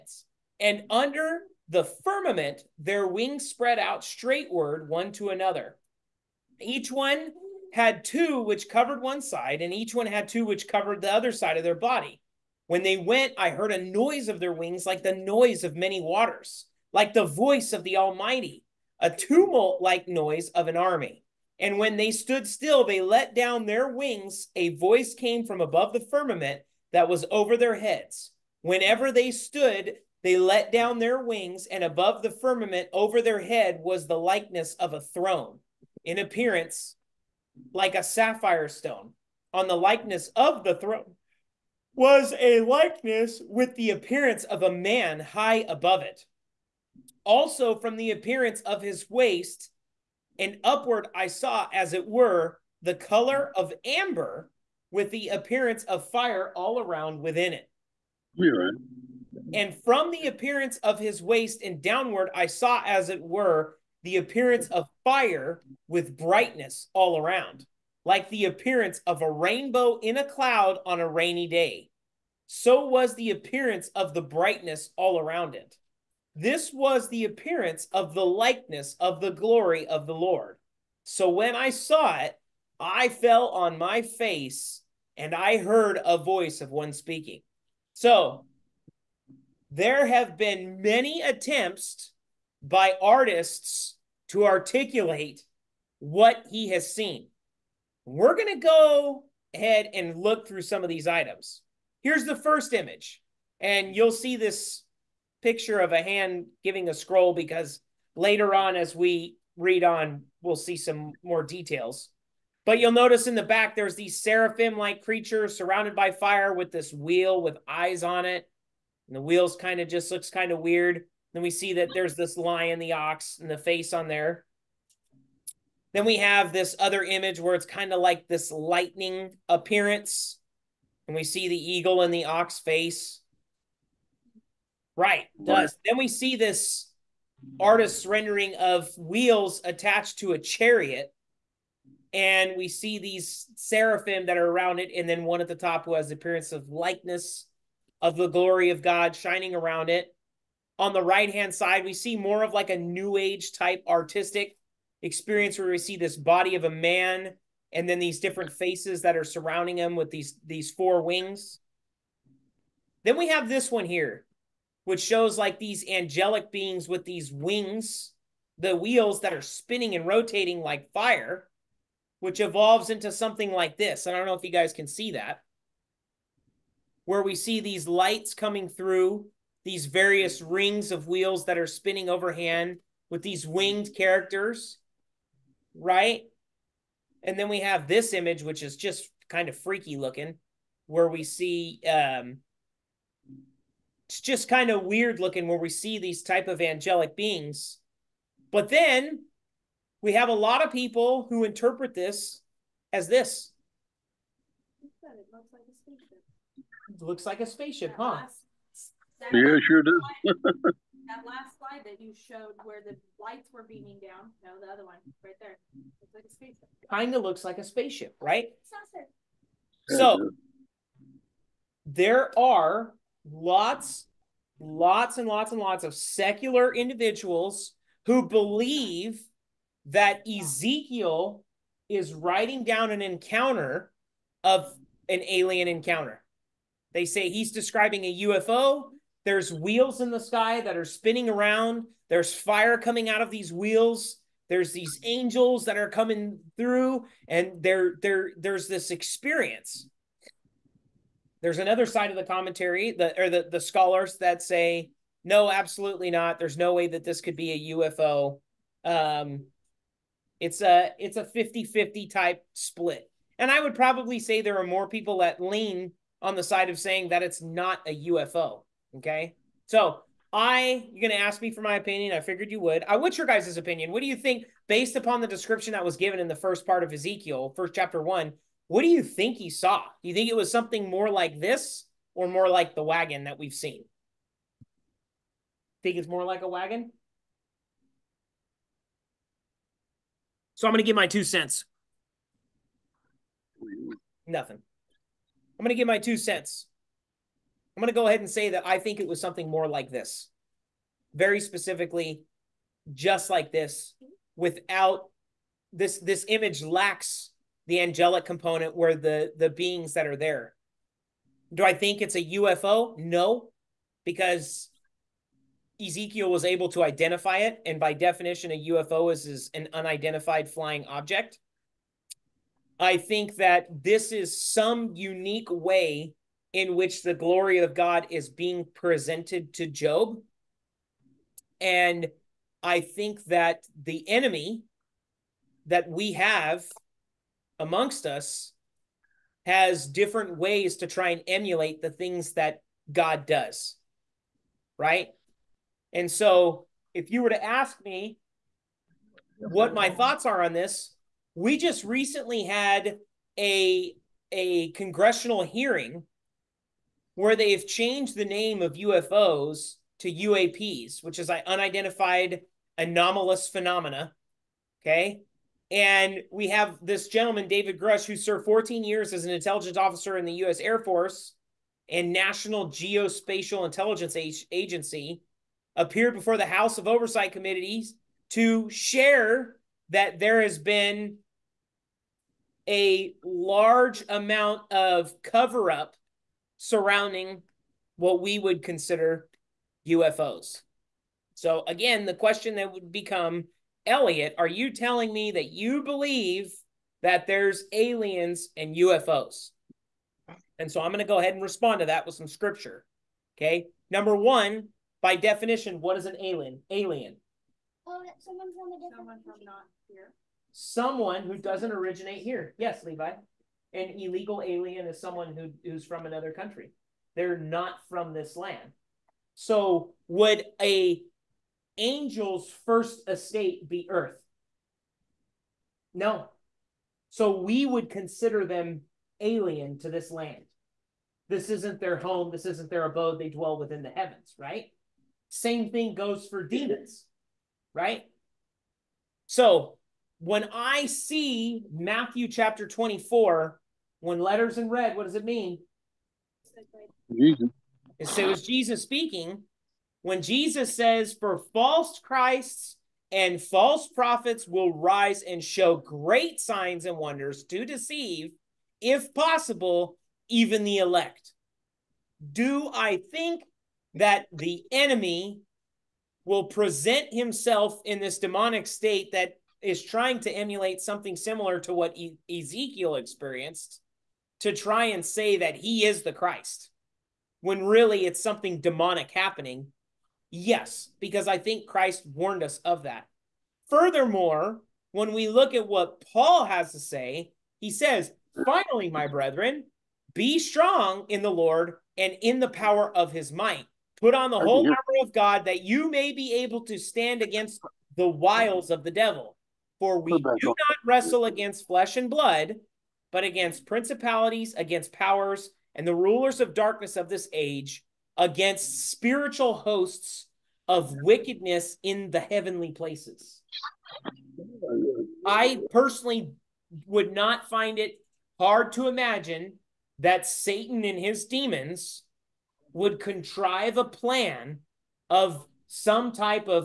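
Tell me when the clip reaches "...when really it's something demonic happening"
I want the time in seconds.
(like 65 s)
477 s.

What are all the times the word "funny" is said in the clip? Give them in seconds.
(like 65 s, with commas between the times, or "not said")
not said.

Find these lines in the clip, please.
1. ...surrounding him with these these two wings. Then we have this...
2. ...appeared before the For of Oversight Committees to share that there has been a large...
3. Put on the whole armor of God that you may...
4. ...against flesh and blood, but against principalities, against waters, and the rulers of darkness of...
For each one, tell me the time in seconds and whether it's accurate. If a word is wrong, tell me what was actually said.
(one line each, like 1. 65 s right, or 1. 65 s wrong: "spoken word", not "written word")
1. 159 s wrong: "four", not "two"
2. 375 s wrong: "House", not "For"
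3. 493 s right
4. 501 s wrong: "powers", not "waters".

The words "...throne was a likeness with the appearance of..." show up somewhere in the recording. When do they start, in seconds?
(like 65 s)
40 s.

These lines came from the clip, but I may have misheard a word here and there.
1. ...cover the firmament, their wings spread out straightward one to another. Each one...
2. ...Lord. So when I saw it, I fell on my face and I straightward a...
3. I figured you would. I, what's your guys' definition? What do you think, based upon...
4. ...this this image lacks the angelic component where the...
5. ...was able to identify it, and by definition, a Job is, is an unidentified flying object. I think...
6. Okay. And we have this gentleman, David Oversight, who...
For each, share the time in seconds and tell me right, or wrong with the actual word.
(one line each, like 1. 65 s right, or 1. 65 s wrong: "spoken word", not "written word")
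1. 0 s wrong: "under", not "cover"
2. 80 s wrong: "heard", not "straightward"
3. 272 s wrong: "opinion", not "definition"
4. 305 s right
5. 316 s wrong: "UFO", not "Job"
6. 364 s wrong: "Grusch", not "Oversight".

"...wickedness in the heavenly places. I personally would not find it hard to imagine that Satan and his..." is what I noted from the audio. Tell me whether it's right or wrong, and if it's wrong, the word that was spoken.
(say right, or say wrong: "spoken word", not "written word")
right.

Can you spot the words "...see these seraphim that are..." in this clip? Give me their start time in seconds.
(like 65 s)
142 s.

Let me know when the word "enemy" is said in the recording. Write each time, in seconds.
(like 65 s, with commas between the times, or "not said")
334 s, 464 s.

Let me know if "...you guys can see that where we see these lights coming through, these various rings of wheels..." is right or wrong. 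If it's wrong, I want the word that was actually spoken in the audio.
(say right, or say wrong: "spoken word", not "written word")
right.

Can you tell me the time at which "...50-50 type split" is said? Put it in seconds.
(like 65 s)
261 s.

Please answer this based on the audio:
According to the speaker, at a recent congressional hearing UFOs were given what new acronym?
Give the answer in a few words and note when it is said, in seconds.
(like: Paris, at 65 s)
UAPs, at 360 s.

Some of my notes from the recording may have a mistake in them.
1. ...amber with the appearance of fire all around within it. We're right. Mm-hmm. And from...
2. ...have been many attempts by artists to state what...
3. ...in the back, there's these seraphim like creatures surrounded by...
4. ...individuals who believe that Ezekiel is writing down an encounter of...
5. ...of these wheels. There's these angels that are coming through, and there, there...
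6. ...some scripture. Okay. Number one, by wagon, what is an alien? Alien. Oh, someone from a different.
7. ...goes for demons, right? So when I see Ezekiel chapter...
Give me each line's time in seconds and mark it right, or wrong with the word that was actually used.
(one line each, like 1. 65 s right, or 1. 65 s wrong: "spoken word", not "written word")
1. 53 s right
2. 90 s wrong: "articulate", not "state"
3. 113 s right
4. 226 s right
5. 243 s right
6. 402 s wrong: "definition", not "wagon"
7. 435 s wrong: "Matthew", not "Ezekiel".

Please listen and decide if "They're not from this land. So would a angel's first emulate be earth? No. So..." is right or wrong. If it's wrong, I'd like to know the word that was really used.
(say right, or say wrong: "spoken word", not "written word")
wrong: "estate", not "emulate".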